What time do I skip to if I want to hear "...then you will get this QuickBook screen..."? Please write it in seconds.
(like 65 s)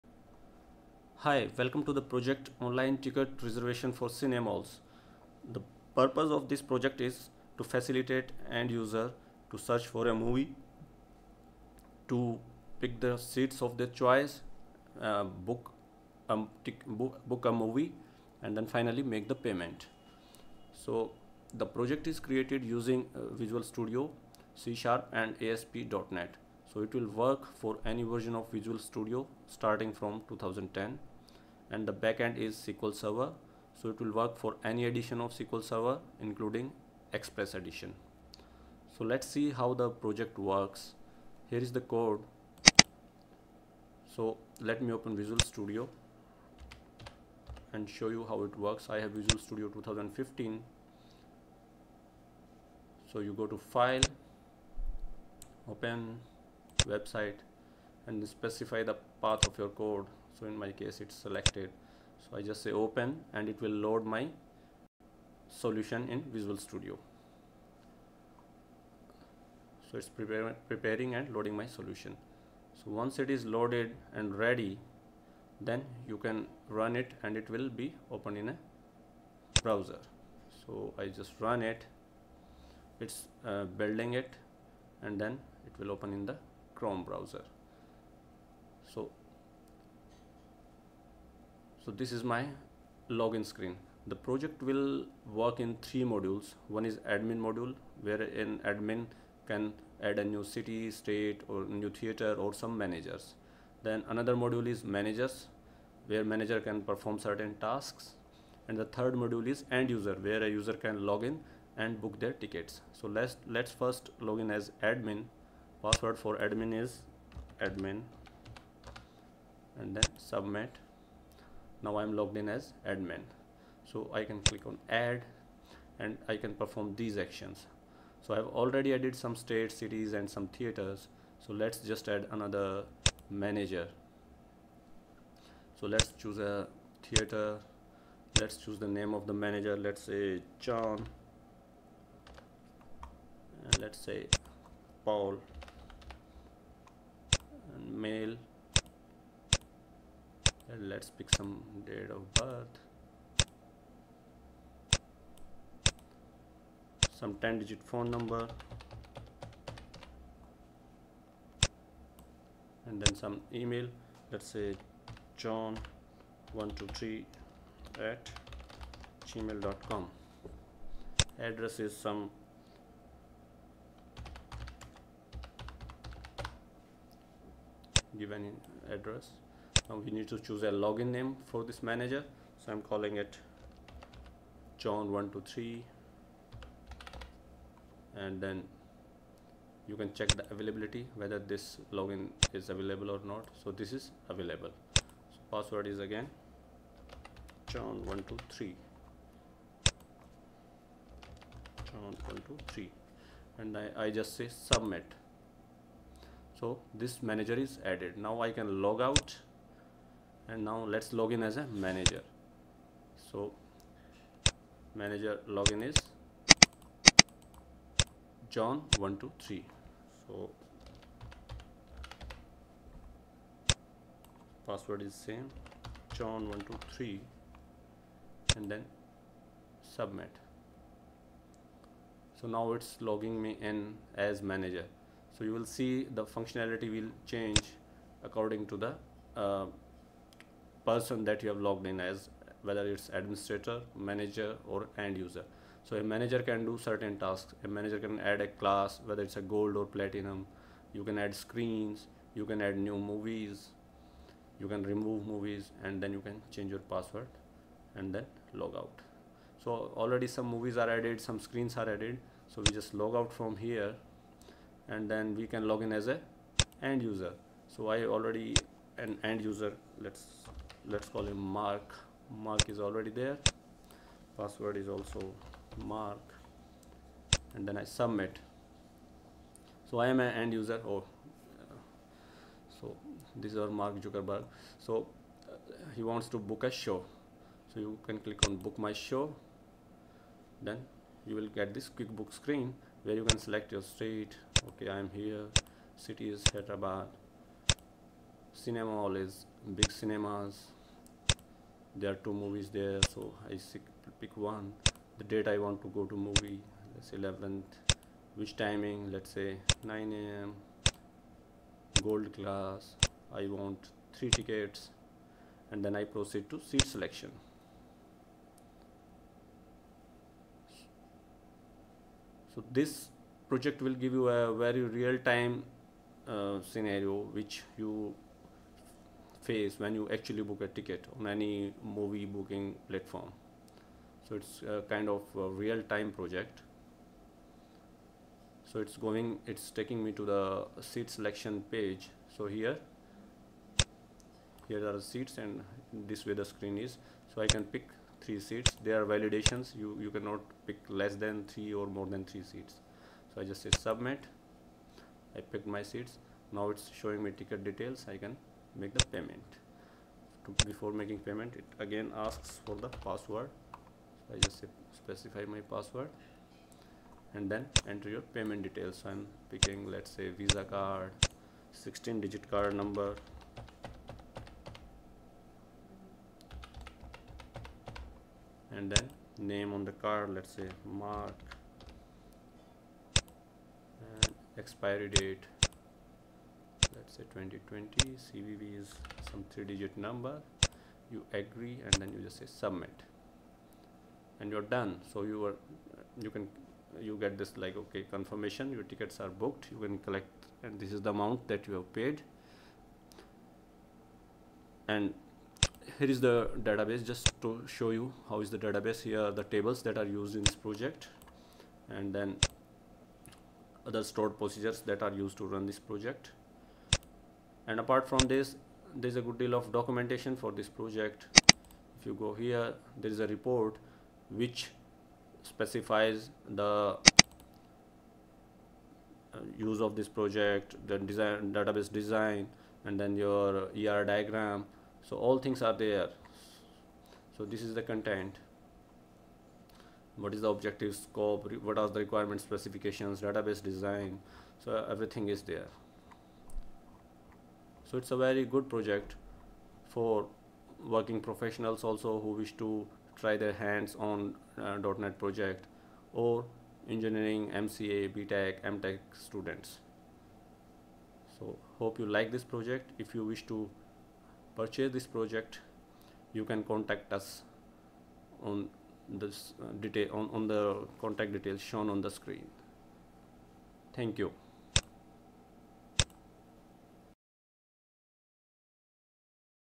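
290 s.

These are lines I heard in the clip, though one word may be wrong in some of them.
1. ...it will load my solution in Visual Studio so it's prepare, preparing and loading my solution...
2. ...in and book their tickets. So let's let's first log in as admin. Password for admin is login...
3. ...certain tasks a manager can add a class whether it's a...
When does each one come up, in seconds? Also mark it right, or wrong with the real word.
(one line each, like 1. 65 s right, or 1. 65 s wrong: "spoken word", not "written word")
1. 63 s right
2. 111 s wrong: "admin", not "login"
3. 246 s right.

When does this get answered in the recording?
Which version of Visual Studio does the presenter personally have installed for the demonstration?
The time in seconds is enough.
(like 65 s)
49 s.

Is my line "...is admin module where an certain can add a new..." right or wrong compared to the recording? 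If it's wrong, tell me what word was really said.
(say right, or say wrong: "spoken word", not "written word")
wrong: "admin", not "certain".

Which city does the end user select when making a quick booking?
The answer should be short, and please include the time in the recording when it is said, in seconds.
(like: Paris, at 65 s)
Hyderabad, at 296 s.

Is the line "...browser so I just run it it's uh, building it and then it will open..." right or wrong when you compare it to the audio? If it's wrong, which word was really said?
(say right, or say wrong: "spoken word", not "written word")
right.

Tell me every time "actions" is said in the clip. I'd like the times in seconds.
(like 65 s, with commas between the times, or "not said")
127 s.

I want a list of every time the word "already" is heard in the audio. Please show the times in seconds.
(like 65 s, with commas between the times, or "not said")
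128 s, 260 s, 268 s, 272 s.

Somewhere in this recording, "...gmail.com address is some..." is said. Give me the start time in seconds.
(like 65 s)
169 s.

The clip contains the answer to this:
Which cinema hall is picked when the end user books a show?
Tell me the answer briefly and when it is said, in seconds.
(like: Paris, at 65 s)
Big Cinemas, at 299 s.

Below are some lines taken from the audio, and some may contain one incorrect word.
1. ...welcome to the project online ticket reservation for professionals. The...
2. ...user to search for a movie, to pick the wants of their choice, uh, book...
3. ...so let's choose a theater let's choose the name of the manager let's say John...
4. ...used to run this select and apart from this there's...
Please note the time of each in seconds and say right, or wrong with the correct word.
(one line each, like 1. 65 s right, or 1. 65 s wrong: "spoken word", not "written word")
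1. 1 s wrong: "cinemalls", not "professionals"
2. 8 s wrong: "seats", not "wants"
3. 135 s right
4. 415 s wrong: "project", not "select".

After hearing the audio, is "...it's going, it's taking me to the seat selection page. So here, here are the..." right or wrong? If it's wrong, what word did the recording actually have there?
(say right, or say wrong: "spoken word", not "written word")
right.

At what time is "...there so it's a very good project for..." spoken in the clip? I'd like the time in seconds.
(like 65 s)
445 s.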